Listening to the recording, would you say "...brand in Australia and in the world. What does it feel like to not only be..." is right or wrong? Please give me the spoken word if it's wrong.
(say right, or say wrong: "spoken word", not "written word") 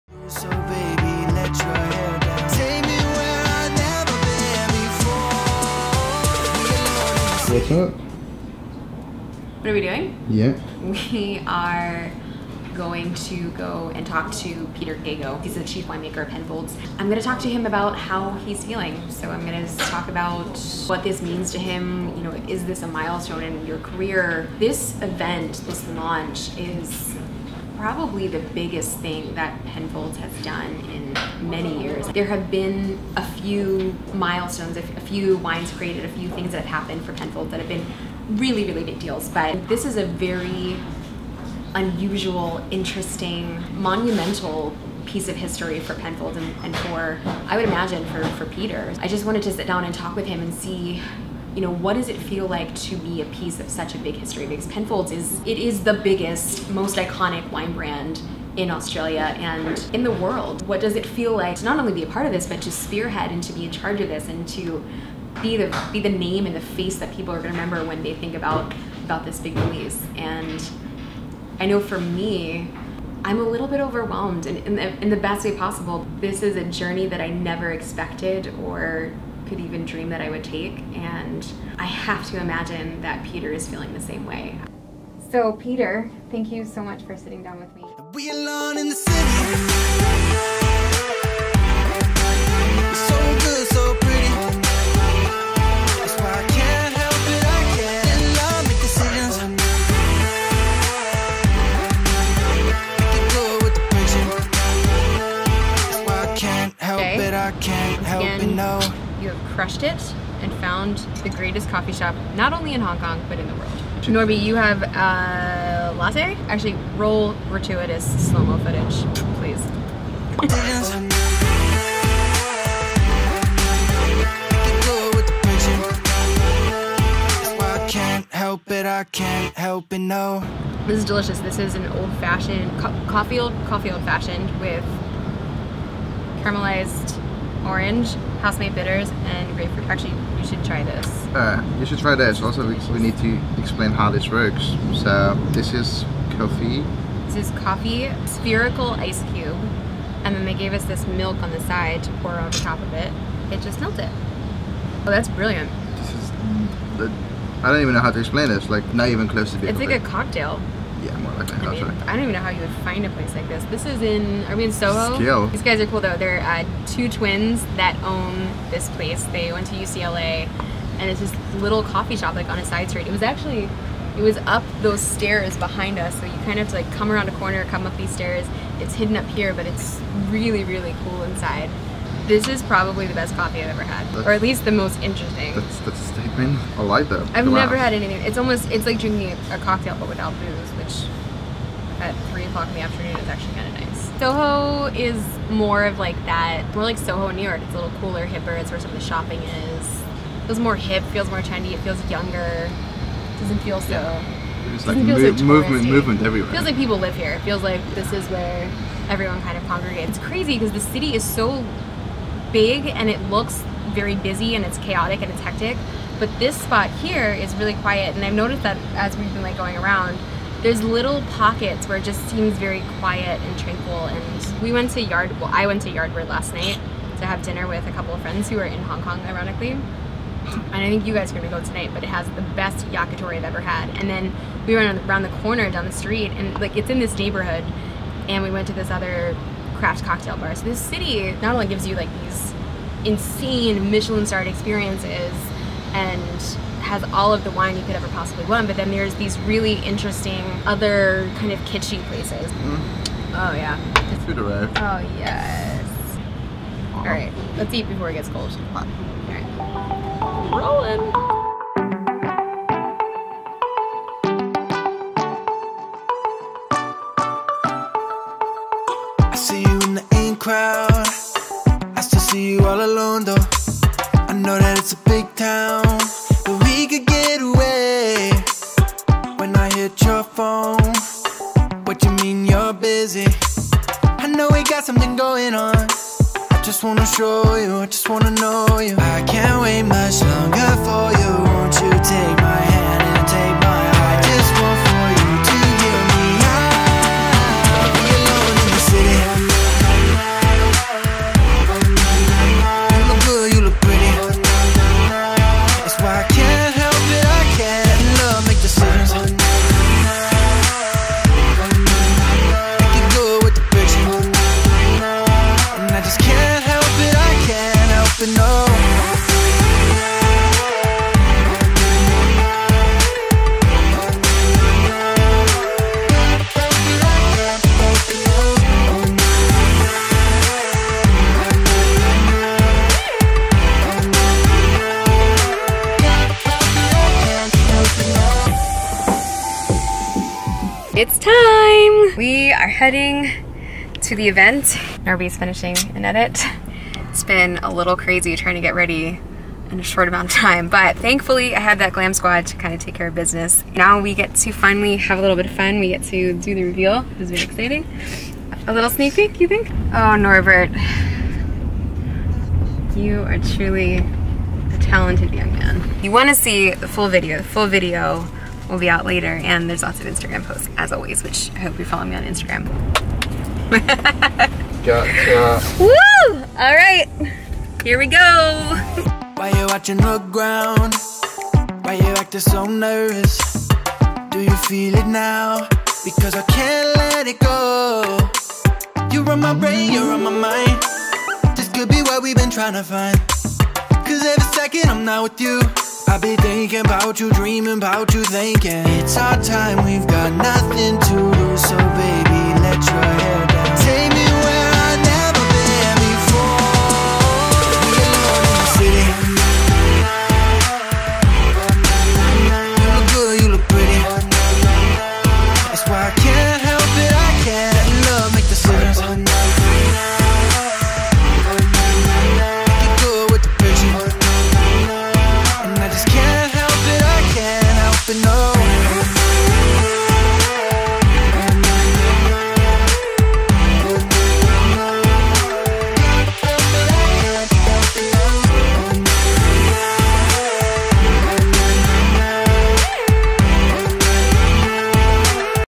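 right.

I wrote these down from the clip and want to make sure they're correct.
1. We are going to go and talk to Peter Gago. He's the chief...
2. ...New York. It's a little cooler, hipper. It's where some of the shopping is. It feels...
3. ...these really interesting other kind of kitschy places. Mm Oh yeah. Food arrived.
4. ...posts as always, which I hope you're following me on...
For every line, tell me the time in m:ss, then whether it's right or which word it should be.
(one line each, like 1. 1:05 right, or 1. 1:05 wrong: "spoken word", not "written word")
1. 0:11 right
2. 3:17 right
3. 4:09 right
4. 6:10 right.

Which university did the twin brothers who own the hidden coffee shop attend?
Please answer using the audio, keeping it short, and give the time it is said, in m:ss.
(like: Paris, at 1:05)
UCLA, at 2:49.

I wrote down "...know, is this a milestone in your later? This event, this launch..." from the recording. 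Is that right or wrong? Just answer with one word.
wrong.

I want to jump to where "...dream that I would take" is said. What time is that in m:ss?
1:19.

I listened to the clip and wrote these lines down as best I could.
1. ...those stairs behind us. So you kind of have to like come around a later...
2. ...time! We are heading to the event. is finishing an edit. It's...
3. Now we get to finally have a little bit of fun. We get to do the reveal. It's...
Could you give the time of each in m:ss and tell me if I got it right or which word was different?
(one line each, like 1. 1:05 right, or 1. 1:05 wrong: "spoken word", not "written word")
1. 2:54 wrong: "corner", not "later"
2. 5:41 right
3. 5:53 right.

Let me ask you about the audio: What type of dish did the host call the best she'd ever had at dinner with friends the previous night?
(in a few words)
Yakitori.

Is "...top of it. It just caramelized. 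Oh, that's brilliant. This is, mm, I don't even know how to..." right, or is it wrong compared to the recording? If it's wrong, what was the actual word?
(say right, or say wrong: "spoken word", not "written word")
wrong: "melted", not "caramelized".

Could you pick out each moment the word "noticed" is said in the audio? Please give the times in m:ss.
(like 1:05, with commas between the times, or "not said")
3:38.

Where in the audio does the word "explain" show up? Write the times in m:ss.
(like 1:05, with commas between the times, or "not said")
2:23, 2:38.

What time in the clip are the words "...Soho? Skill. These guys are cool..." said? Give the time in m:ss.
2:44.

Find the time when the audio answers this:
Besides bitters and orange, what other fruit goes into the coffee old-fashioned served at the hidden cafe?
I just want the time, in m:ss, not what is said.
2:19.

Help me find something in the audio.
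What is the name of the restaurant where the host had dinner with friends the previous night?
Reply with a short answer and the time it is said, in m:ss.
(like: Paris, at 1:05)
Yardbird, at 3:45.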